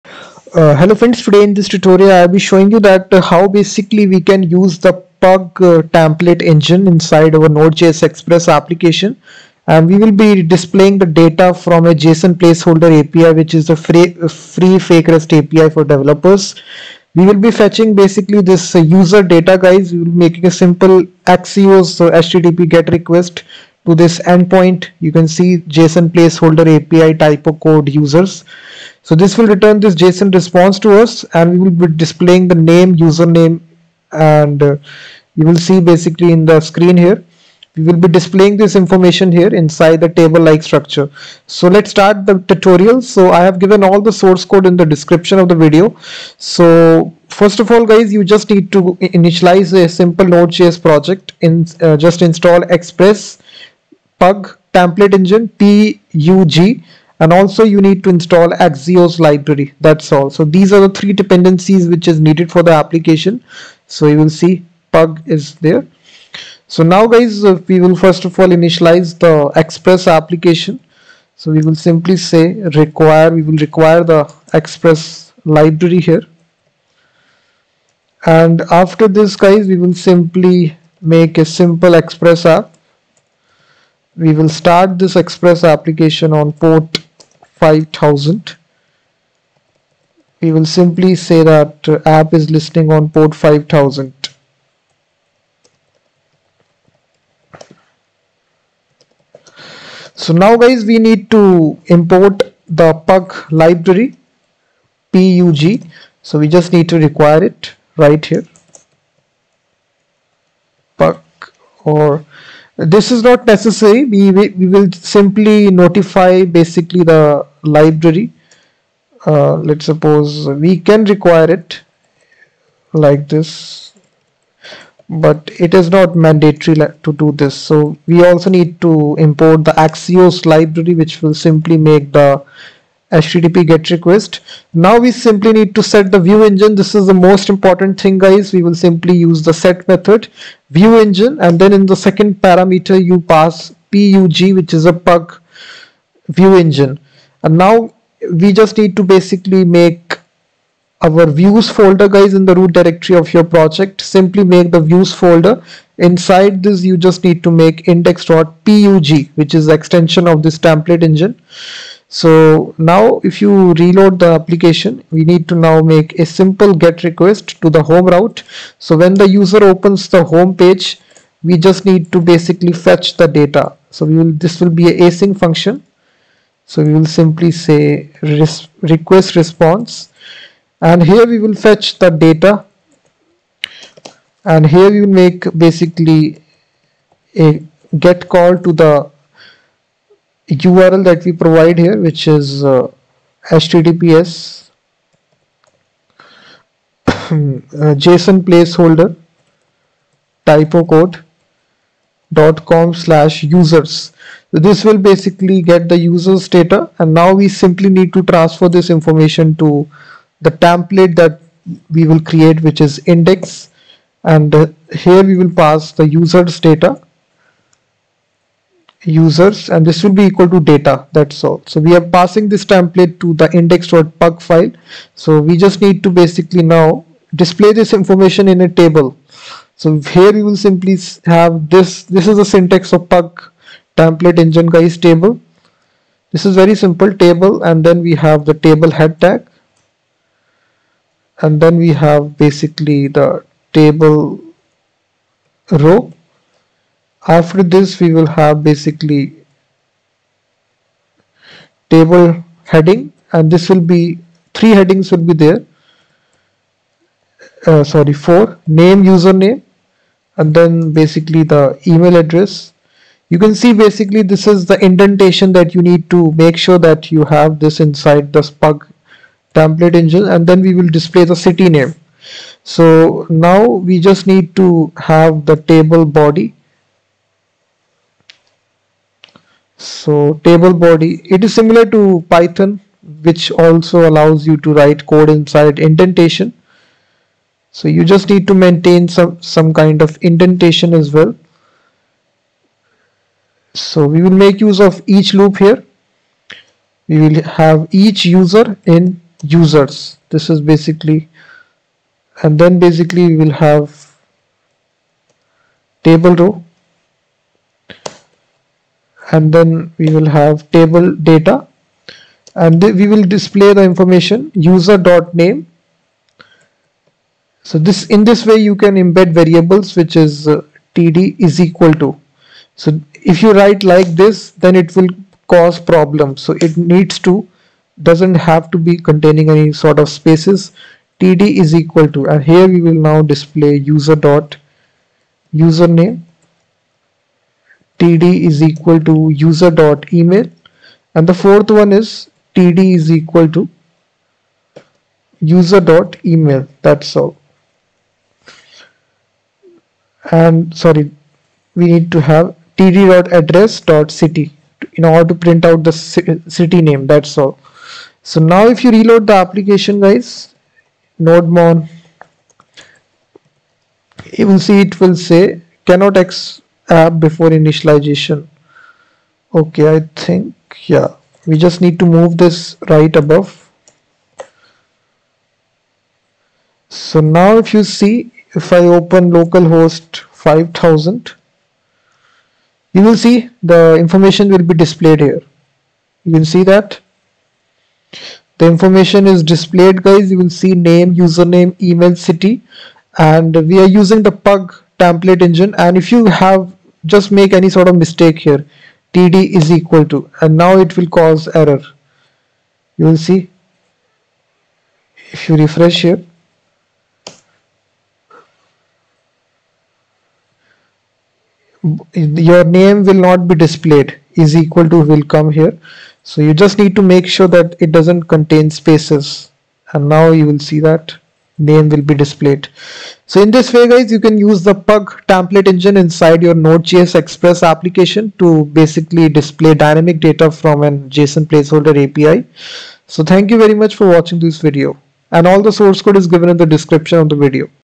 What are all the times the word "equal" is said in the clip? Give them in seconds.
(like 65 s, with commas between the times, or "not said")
220 s, 321 s, 331 s, 338 s, 343 s, 399 s, 414 s.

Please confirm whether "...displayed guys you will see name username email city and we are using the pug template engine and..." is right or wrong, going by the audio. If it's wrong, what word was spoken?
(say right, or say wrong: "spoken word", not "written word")
right.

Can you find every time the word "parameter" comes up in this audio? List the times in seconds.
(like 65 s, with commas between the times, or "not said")
142 s.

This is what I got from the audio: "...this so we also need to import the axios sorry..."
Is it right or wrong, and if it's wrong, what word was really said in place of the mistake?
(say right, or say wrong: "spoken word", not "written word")
wrong: "library", not "sorry".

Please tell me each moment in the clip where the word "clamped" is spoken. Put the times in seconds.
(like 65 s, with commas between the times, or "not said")
not said.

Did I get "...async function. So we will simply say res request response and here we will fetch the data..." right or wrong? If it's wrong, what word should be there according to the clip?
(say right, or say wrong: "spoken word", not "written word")
right.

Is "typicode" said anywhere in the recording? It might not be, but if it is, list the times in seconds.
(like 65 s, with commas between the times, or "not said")
27 s, 200 s.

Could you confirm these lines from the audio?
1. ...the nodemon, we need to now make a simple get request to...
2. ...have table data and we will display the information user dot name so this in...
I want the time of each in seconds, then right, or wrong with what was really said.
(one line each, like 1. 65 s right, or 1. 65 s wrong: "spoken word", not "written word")
1. 164 s wrong: "application", not "nodemon"
2. 310 s right.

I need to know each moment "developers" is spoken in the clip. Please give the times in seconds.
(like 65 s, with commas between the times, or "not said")
15 s.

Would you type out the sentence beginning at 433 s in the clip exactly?
So thank you very much for watching this video and all the source code is given in the description of the video.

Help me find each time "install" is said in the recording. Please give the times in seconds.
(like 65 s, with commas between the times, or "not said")
52 s, 58 s.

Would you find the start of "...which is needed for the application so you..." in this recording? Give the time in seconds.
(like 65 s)
61 s.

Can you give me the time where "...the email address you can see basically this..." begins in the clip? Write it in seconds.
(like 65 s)
261 s.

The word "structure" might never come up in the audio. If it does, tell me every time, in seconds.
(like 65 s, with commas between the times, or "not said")
40 s.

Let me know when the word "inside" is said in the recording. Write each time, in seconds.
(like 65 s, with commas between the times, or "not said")
6 s, 39 s, 155 s, 267 s, 285 s, 425 s.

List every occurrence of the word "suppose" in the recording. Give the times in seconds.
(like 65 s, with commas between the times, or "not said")
119 s.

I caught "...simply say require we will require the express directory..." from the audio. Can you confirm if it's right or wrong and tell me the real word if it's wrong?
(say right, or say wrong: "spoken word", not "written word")
wrong: "library", not "directory".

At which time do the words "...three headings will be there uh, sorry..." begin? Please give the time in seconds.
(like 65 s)
254 s.